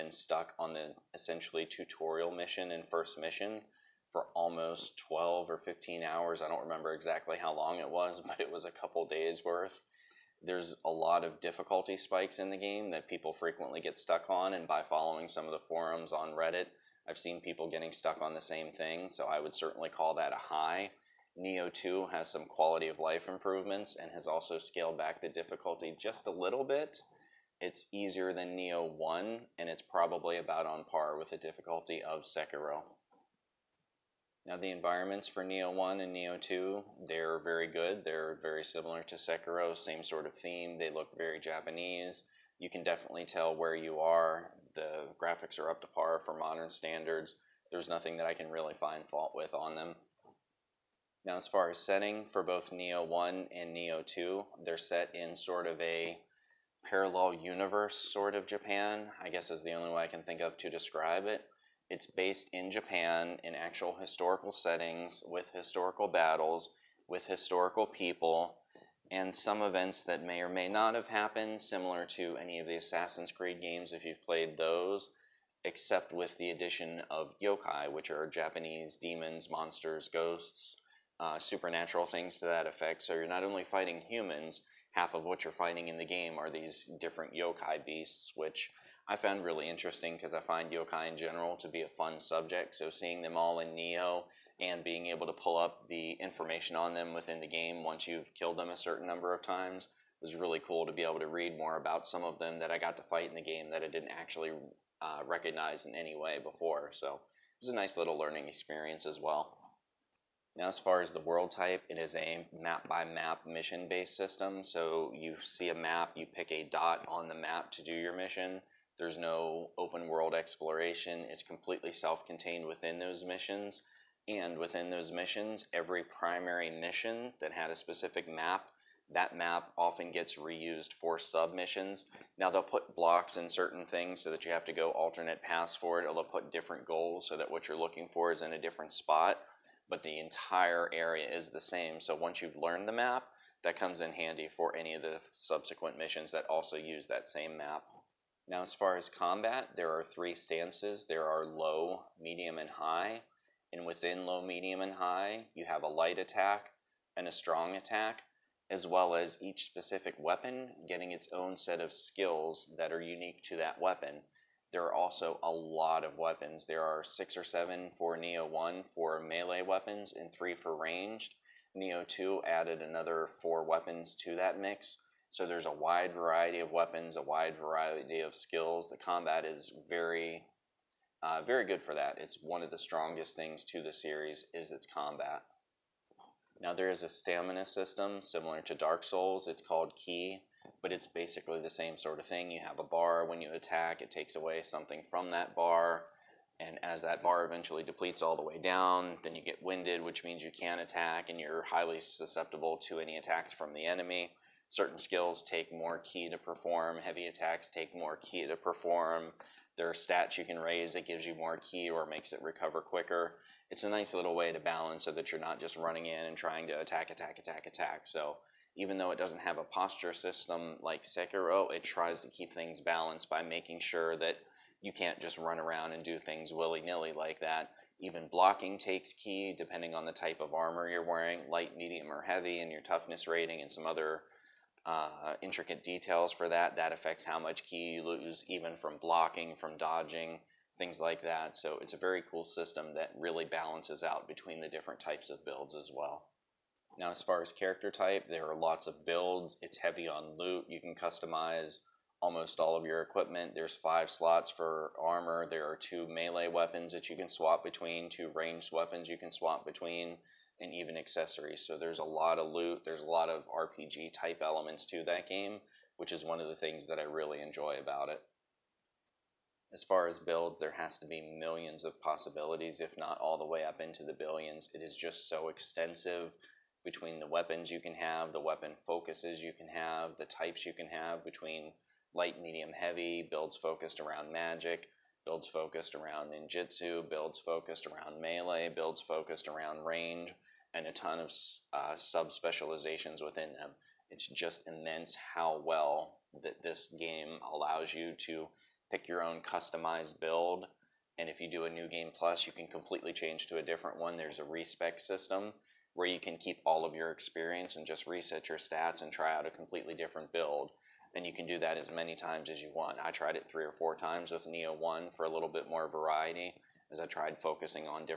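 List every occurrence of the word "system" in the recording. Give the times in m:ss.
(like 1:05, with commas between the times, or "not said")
1:54, 3:07, 3:40, 4:02, 5:04.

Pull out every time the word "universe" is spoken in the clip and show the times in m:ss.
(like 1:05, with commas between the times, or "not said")
0:57.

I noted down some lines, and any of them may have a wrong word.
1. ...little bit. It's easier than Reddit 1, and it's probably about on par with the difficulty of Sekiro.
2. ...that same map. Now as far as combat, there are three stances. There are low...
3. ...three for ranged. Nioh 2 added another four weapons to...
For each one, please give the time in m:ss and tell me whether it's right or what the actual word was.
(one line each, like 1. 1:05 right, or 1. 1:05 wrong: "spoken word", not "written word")
1. 0:26 wrong: "Nioh", not "Reddit"
2. 2:27 right
3. 2:50 right.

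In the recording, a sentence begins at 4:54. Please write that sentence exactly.
It's just immense how well that this game allows you to pick your own customized build.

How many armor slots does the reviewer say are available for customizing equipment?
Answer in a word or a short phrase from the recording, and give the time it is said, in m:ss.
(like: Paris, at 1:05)
5, at 4:13.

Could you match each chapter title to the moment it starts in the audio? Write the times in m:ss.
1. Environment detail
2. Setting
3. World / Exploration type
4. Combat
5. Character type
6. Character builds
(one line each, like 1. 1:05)
1. 0:33
2. 0:49
3. 1:49
4. 2:25
5. 4:05
6. 4:28.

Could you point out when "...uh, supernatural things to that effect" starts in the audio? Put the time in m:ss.
1:21.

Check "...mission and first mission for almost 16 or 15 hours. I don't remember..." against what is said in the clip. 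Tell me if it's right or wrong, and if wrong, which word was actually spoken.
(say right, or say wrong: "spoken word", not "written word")
wrong: "12", not "16".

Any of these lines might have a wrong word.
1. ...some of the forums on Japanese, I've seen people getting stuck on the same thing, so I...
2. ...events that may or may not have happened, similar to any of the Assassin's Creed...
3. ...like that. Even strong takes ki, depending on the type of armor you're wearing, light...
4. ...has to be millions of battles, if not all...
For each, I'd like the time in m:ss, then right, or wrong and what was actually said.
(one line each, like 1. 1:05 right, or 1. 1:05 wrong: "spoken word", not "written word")
1. 0:15 wrong: "Reddit", not "Japanese"
2. 1:09 right
3. 3:47 wrong: "blocking", not "strong"
4. 4:30 wrong: "possibilities", not "battles".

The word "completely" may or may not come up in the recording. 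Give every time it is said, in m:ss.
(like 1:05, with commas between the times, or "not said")
2:01, 5:02, 5:09.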